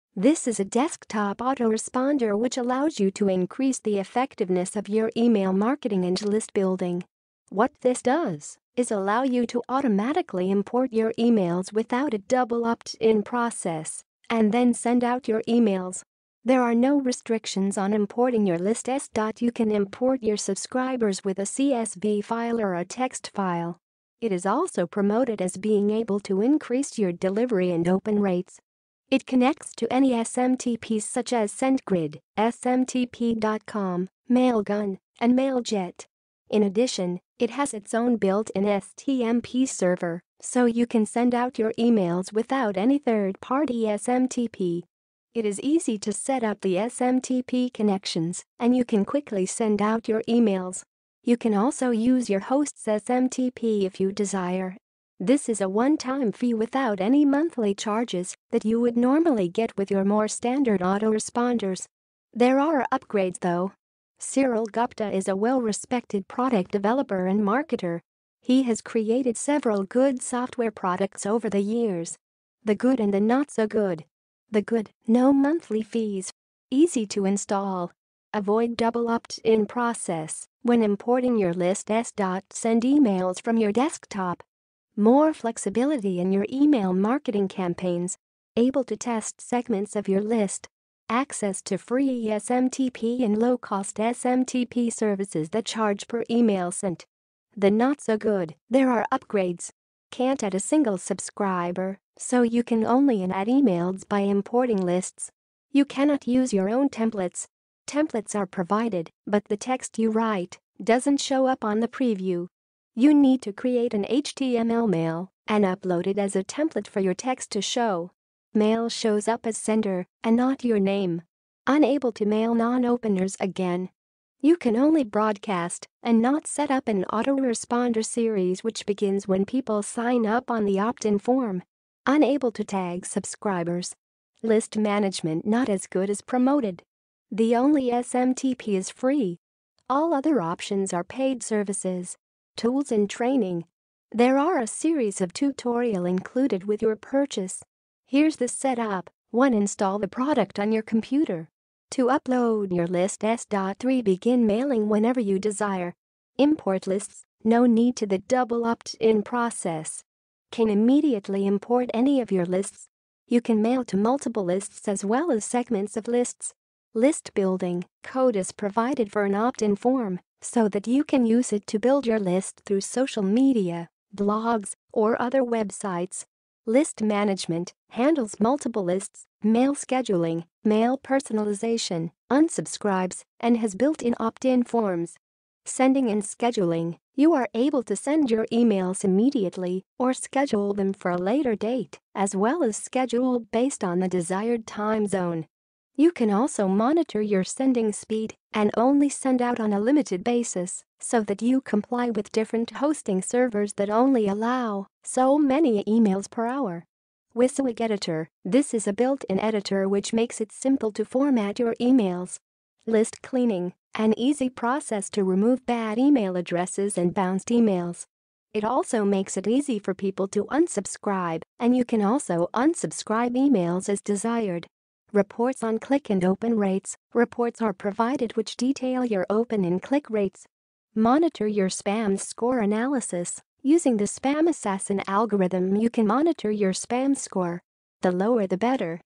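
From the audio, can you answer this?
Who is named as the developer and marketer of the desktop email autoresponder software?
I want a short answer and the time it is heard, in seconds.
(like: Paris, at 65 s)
Cyril Gupta, at 64 s.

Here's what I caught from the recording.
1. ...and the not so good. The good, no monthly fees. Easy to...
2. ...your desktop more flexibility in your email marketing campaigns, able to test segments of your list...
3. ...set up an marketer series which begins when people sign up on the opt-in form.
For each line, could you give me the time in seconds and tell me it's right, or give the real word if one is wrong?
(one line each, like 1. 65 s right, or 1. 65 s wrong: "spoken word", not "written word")
1. 72 s right
2. 83 s right
3. 126 s wrong: "autoresponder", not "marketer".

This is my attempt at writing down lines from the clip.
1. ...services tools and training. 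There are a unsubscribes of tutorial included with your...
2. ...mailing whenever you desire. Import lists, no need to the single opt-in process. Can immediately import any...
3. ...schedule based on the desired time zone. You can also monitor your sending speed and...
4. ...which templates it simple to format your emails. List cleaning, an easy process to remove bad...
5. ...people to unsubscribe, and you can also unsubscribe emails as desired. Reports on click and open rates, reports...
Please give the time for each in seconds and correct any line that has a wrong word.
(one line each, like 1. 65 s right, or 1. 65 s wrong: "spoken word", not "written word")
1. 141 s wrong: "series", not "unsubscribes"
2. 154 s wrong: "double", not "single"
3. 192 s right
4. 209 s wrong: "makes", not "templates"
5. 219 s right.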